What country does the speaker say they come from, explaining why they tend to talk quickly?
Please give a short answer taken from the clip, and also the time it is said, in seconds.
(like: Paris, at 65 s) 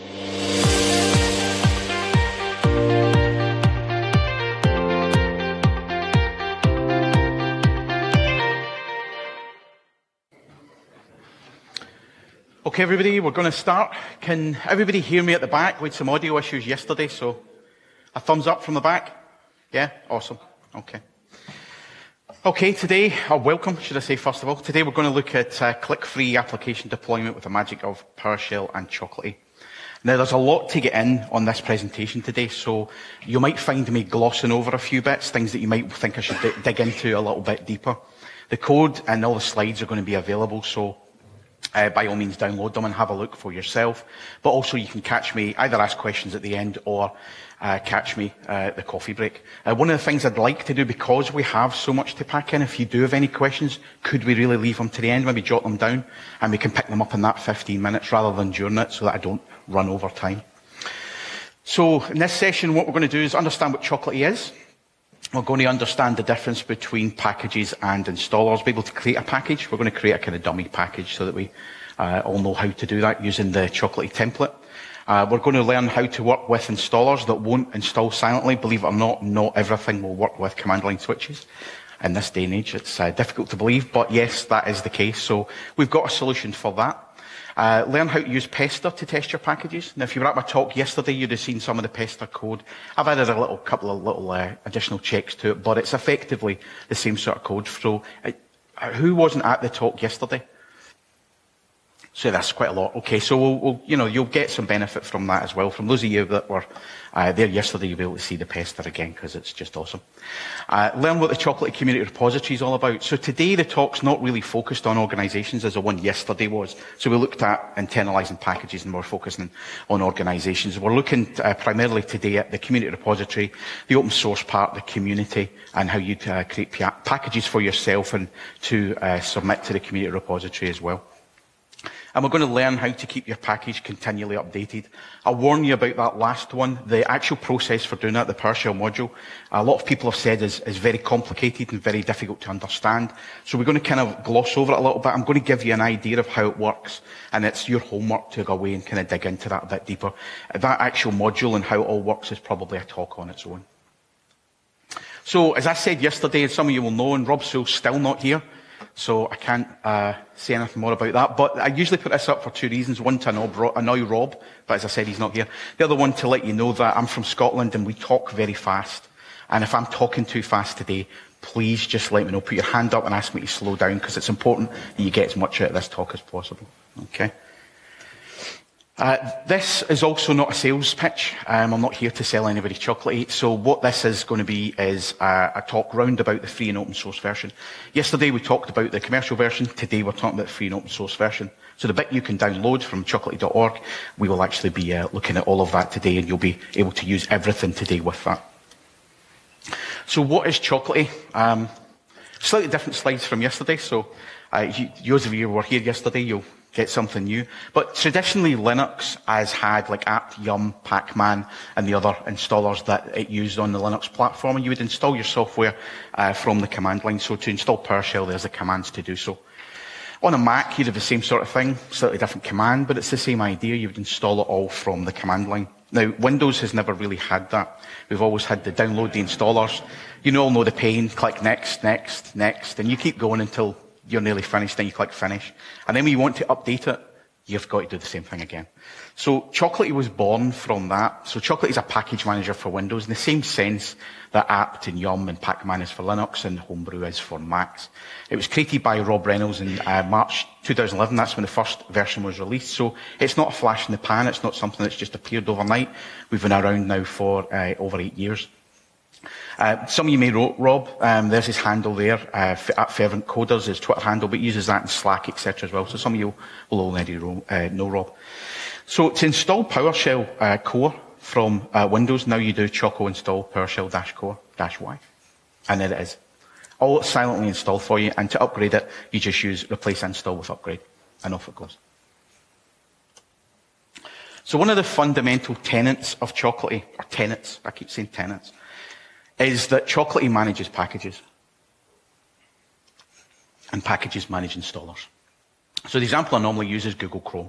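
Scotland, at 167 s.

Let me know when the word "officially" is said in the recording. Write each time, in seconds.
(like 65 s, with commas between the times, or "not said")
not said.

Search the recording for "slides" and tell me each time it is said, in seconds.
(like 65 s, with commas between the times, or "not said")
39 s, 202 s.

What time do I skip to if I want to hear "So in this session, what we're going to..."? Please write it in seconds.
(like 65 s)
61 s.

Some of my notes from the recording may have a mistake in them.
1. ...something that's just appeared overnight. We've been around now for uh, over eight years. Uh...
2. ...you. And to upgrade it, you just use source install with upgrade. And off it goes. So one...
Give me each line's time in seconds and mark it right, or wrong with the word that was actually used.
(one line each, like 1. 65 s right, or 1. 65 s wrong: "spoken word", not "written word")
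1. 254 s right
2. 277 s wrong: "replace", not "source".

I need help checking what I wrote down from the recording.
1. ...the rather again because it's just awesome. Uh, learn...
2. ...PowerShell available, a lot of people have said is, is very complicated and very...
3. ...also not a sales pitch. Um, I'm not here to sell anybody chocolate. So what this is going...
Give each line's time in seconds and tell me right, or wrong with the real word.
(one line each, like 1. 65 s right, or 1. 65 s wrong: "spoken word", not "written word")
1. 108 s wrong: "pester", not "rather"
2. 138 s wrong: "module", not "available"
3. 180 s right.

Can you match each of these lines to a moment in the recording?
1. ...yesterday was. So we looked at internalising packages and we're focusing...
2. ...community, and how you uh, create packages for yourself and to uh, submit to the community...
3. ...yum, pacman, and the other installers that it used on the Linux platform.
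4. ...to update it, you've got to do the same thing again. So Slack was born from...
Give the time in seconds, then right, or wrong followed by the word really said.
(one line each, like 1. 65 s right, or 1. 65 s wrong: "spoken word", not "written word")
1. 115 s right
2. 124 s right
3. 210 s right
4. 236 s wrong: "Chocolatey", not "Slack".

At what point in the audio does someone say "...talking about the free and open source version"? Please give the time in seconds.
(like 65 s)
190 s.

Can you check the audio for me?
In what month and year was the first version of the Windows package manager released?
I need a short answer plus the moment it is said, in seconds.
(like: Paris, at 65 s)
March 2011, at 250 s.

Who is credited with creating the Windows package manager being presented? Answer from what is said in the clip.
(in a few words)
Rob Reynolds.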